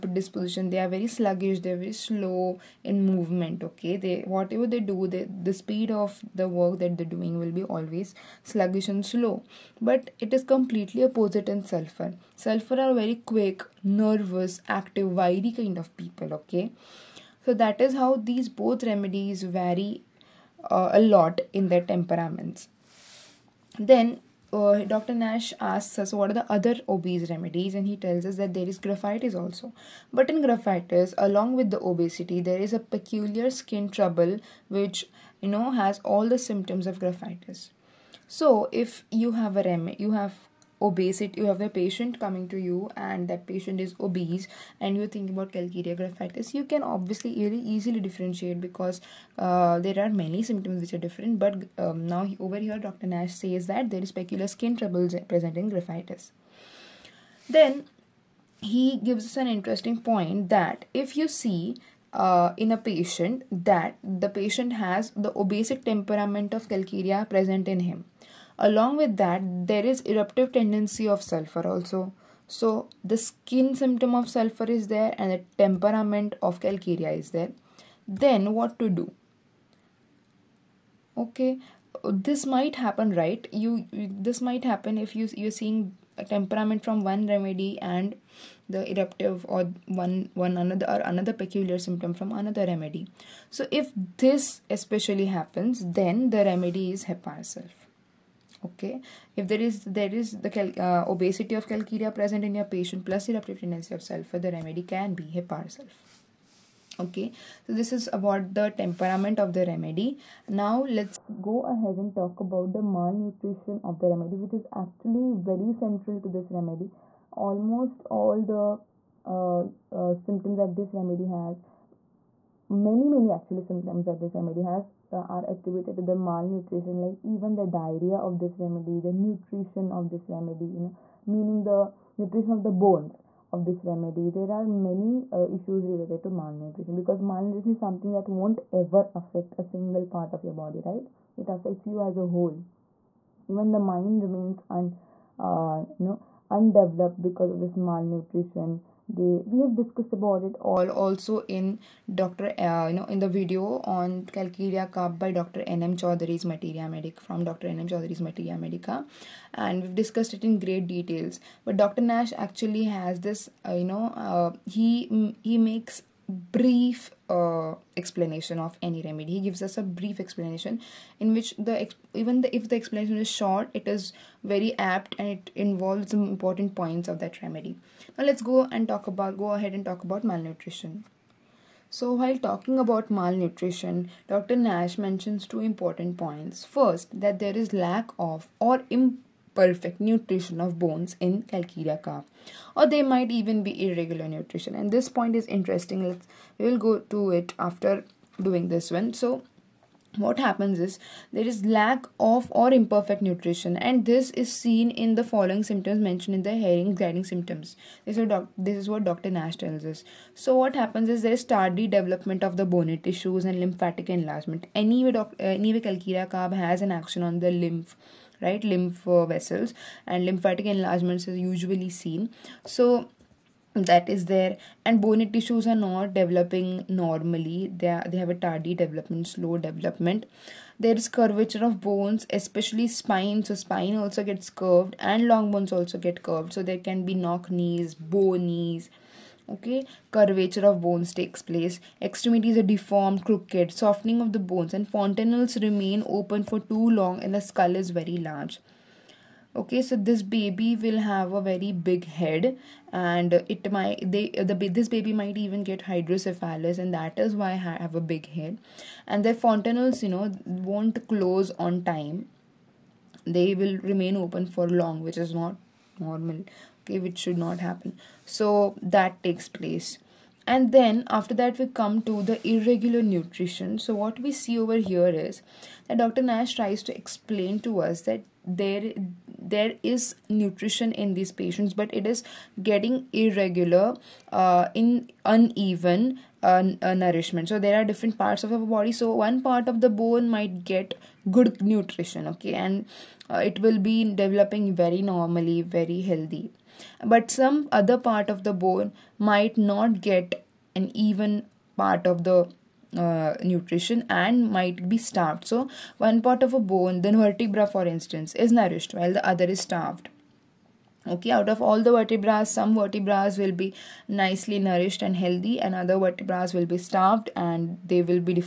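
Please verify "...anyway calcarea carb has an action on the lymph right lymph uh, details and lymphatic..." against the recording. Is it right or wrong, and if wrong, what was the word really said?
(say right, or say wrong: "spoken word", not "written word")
wrong: "vessels", not "details".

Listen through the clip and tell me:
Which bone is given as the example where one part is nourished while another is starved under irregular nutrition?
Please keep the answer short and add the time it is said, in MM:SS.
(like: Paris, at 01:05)
Vertebra, at 05:07.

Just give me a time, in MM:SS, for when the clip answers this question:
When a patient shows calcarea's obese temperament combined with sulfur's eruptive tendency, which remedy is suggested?
01:45.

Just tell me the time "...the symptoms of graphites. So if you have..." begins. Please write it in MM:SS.
00:36.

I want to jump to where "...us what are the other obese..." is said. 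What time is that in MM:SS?
00:25.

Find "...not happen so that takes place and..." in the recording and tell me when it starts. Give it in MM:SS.
04:27.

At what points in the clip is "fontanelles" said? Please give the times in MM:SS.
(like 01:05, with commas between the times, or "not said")
04:04, 04:19.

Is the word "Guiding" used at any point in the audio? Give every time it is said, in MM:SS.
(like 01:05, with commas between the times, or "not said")
03:26.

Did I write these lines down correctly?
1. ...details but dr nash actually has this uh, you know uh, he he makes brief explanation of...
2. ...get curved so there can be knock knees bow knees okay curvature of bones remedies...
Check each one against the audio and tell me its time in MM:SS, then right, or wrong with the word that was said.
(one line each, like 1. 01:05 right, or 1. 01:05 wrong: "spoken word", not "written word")
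1. 02:40 right
2. 03:55 wrong: "takes", not "remedies".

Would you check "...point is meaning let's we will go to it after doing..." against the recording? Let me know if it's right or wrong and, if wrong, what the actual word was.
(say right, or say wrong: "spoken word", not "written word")
wrong: "interesting", not "meaning".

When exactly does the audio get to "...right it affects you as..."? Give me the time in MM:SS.
02:20.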